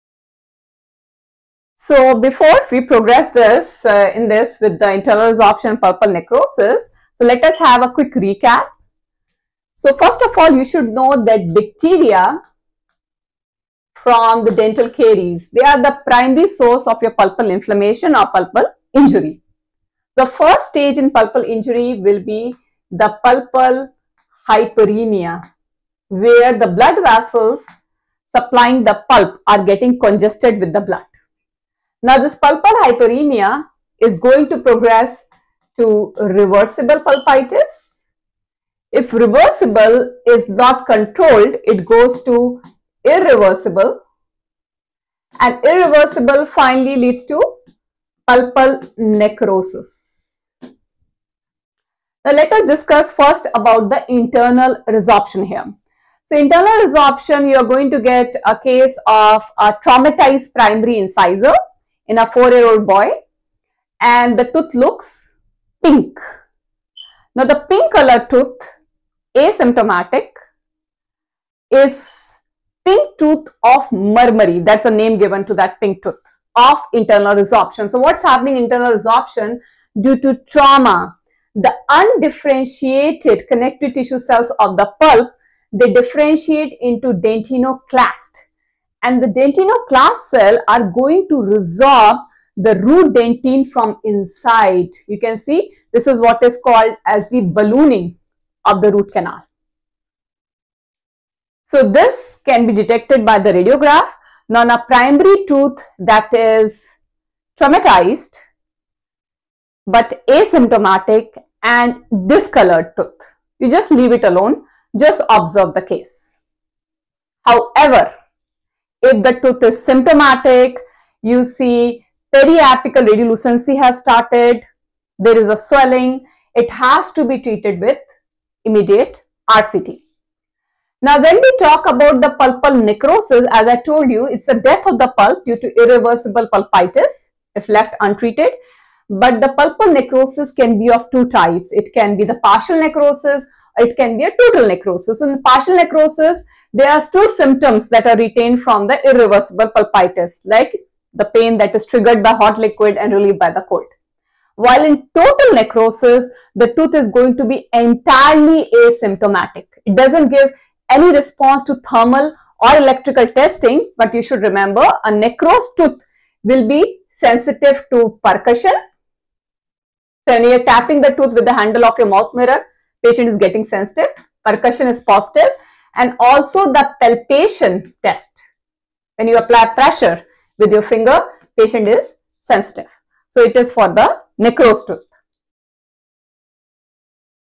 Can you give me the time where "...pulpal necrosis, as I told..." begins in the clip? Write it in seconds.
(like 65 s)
132 s.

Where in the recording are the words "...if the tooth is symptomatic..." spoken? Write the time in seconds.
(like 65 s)
119 s.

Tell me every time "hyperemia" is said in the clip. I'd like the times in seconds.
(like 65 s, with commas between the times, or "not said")
24 s, 32 s.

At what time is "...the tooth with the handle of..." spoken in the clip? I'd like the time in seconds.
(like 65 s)
171 s.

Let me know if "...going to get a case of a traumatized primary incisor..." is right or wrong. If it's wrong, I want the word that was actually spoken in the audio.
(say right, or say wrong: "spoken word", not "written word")
right.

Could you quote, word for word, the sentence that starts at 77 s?
So what's happening internal resorption due to trauma?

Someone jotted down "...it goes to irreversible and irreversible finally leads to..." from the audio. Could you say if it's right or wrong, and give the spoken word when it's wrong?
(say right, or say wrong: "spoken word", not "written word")
right.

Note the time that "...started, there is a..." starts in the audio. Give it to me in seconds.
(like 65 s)
123 s.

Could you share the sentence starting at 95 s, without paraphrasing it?
You can see this is what is called as the ballooning of the root canal.